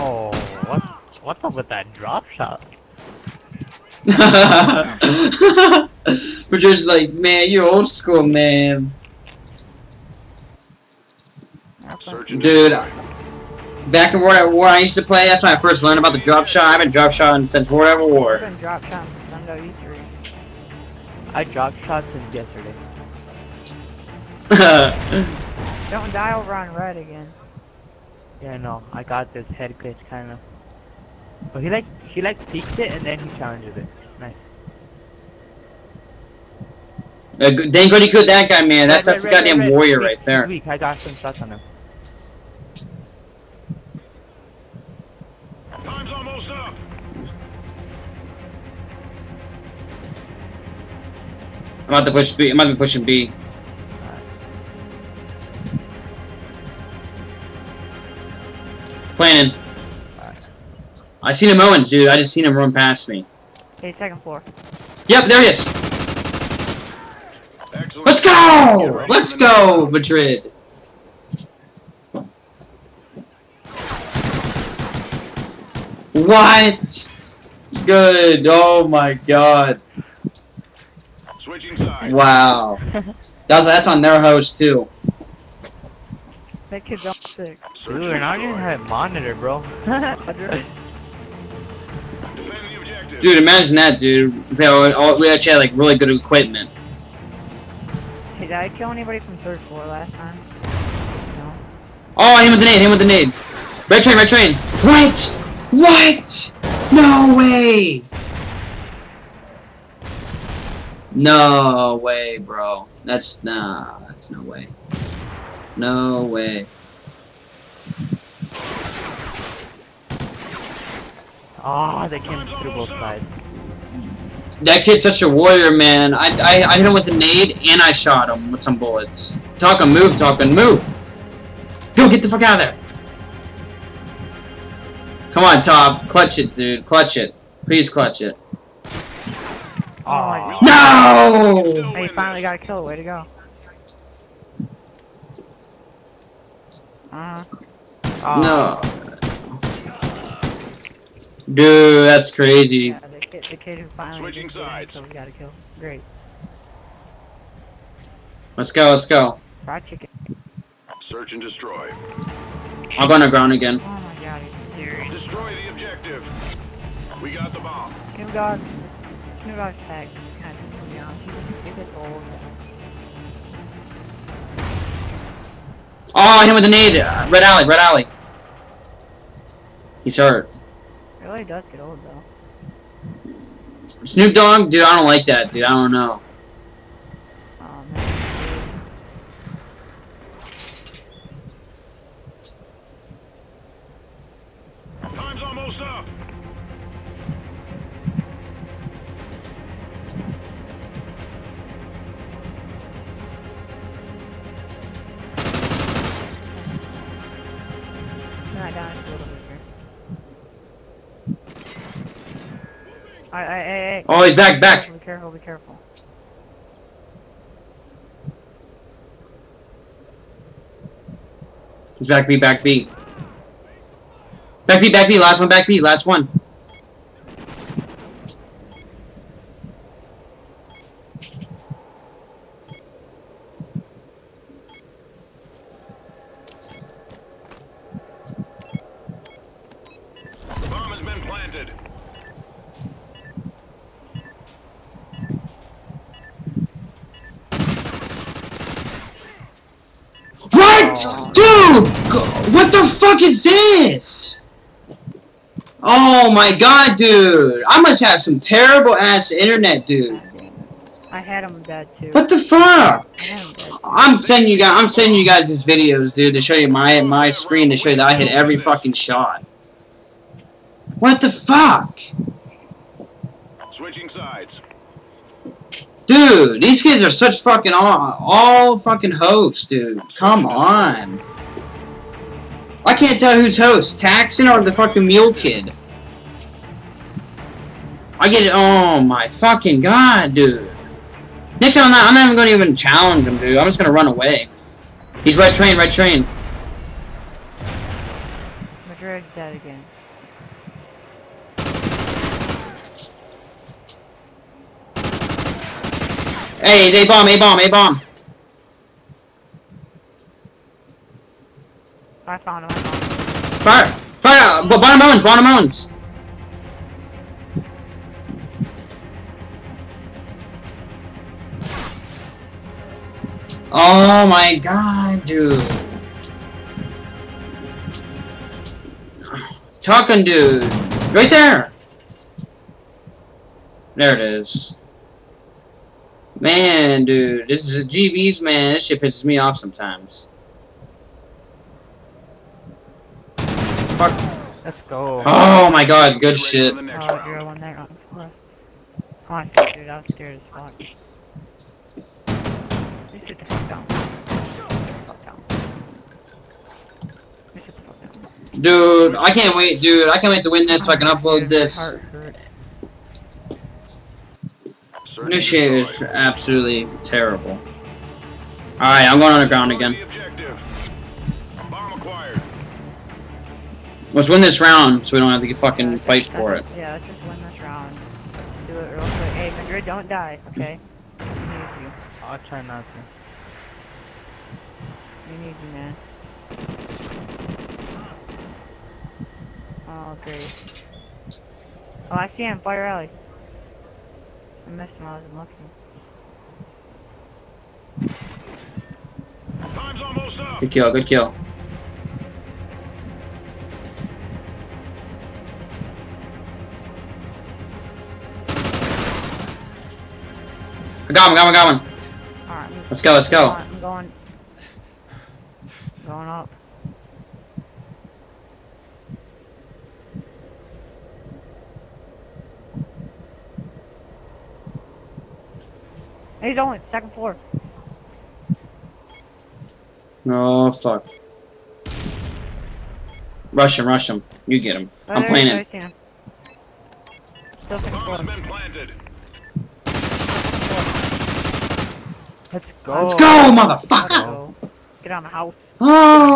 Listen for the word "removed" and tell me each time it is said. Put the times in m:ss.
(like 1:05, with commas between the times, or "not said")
not said.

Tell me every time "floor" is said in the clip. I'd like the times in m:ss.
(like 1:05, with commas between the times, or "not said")
1:04, 1:39, 7:07, 7:17.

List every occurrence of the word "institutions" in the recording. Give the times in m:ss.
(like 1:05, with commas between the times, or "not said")
not said.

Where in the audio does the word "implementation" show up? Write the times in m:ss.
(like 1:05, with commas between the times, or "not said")
not said.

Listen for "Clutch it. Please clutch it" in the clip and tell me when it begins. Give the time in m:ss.
2:16.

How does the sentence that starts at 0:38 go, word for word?
That's that's a goddamn warrior right there.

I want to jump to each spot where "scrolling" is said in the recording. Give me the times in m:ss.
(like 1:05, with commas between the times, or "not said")
not said.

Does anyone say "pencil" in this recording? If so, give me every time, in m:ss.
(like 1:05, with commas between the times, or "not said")
not said.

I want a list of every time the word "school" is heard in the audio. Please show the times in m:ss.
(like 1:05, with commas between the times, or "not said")
0:07.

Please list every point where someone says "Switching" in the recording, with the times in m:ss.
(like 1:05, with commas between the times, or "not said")
1:21, 2:34, 4:33.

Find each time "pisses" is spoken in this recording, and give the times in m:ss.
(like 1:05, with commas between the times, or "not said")
5:39.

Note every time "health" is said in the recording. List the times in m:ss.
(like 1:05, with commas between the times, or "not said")
not said.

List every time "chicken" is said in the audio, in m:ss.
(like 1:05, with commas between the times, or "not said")
2:39.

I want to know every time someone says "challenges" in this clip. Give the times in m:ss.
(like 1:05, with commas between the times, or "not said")
0:33, 4:52.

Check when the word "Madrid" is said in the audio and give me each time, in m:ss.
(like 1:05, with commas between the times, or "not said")
1:09, 4:58, 6:19.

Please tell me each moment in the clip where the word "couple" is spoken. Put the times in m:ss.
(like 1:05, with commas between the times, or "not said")
not said.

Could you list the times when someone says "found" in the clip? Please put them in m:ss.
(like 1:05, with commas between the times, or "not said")
5:12.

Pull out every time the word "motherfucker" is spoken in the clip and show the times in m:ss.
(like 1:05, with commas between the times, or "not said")
7:23.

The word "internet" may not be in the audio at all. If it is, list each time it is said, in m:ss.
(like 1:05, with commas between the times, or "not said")
4:19.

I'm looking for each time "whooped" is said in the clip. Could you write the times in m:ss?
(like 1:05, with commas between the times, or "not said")
not said.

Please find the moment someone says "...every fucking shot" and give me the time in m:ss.
4:28.